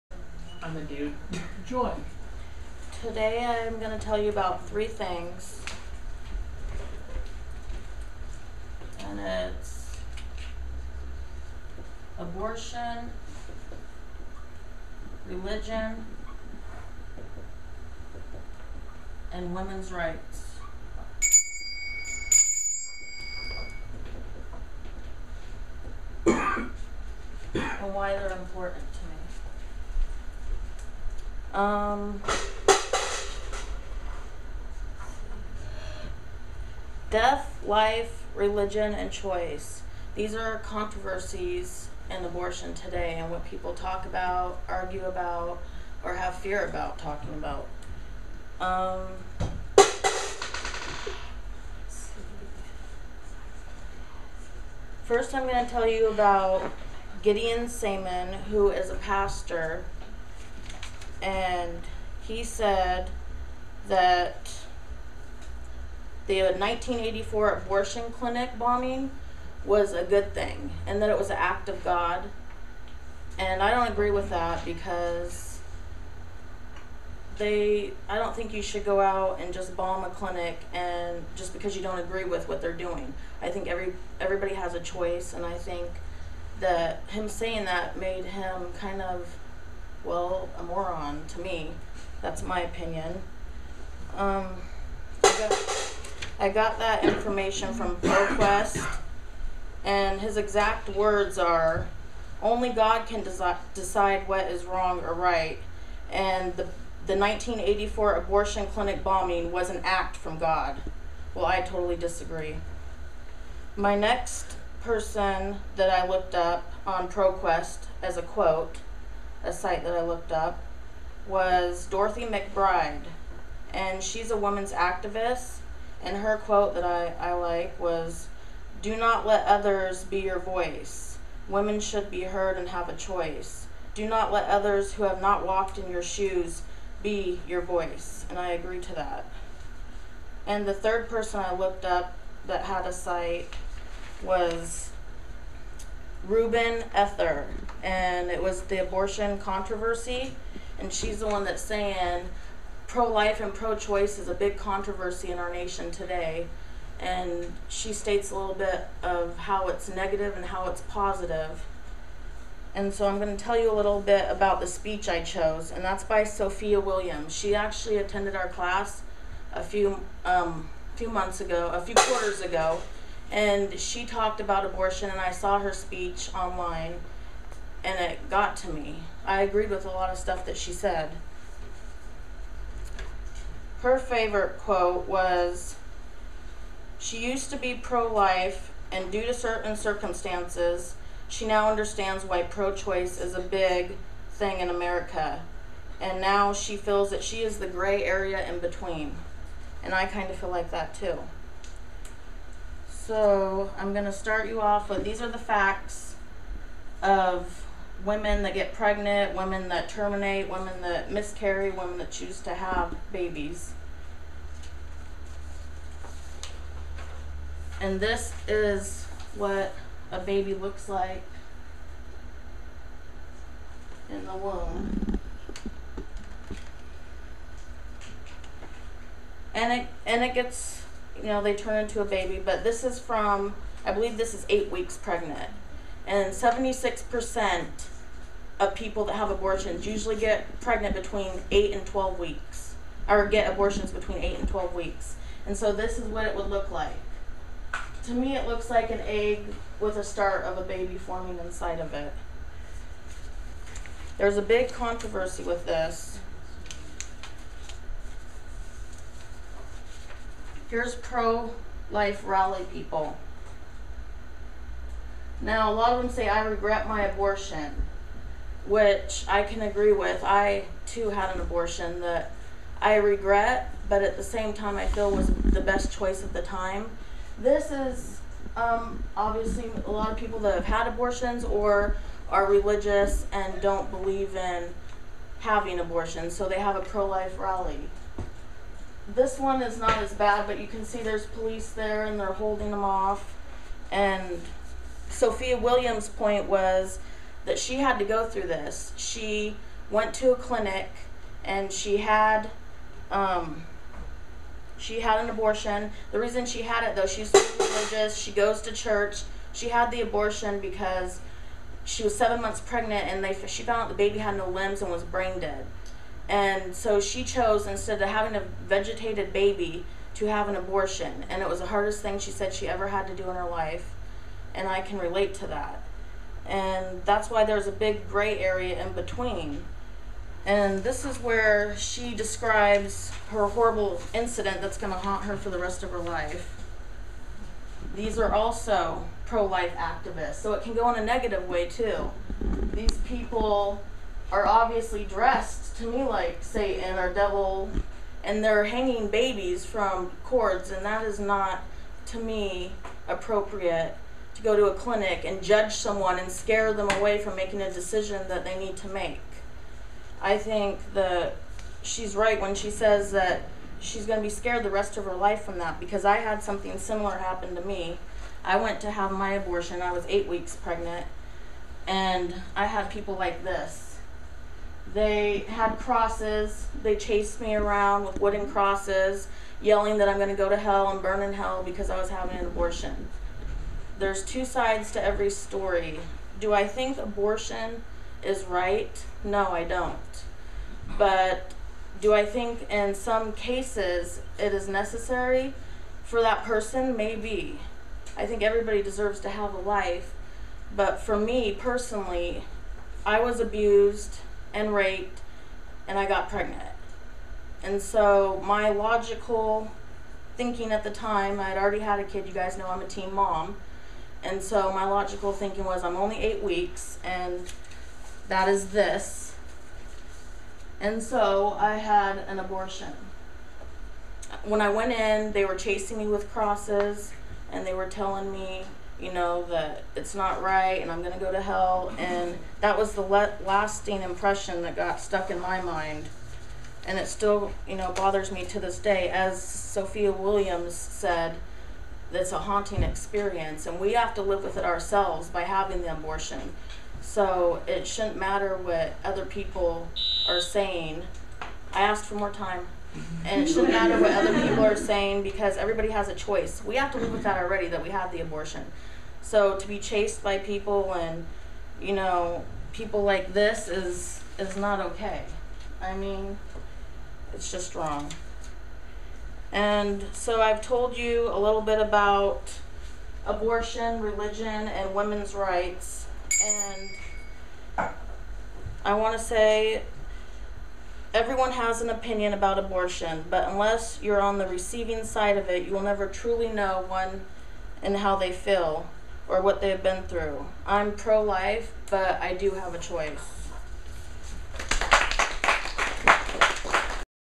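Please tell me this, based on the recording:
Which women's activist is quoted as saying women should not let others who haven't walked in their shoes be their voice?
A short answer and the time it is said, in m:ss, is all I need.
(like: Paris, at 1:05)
Dorothy McBride, at 2:01.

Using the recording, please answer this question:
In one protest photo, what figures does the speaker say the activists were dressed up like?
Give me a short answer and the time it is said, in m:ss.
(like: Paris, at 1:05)
Satan or devil, at 5:46.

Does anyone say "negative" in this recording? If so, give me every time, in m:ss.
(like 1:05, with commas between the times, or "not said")
2:39, 5:41.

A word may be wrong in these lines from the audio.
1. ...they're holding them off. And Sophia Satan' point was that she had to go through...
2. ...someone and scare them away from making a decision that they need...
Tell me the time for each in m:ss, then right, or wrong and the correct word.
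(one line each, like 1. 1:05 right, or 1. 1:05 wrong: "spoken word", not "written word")
1. 4:52 wrong: "Williams", not "Satan"
2. 5:55 right.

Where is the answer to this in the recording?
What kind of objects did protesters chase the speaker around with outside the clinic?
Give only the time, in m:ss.
6:18.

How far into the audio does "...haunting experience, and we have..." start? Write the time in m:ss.
7:22.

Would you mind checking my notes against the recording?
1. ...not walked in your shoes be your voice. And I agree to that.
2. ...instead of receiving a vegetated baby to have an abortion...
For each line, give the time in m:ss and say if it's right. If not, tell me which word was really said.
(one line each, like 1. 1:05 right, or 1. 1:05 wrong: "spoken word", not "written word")
1. 2:15 right
2. 5:17 wrong: "having", not "receiving".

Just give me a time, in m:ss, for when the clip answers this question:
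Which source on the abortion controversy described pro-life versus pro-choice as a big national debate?
2:26.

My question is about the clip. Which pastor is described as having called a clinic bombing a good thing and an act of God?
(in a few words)
Gideon Seaman.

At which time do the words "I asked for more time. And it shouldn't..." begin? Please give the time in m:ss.
7:31.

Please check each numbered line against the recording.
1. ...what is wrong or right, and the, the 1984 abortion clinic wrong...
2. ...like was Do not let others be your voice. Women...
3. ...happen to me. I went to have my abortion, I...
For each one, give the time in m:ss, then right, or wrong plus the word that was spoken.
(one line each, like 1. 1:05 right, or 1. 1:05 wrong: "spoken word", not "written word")
1. 1:44 wrong: "bombing", not "wrong"
2. 2:07 right
3. 6:07 right.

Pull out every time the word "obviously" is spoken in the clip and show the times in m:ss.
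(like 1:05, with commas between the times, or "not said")
4:39, 5:44.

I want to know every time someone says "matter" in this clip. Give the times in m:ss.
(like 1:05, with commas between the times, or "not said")
7:28, 7:33.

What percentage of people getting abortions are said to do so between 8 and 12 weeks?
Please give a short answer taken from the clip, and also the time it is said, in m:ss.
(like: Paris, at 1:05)
76%, at 3:56.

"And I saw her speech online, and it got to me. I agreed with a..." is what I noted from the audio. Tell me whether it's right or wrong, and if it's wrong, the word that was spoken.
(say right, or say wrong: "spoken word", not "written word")
right.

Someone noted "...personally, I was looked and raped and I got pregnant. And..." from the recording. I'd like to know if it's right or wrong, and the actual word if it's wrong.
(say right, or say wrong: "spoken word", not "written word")
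wrong: "abused", not "looked".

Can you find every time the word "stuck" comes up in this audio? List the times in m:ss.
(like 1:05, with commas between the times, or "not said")
7:14.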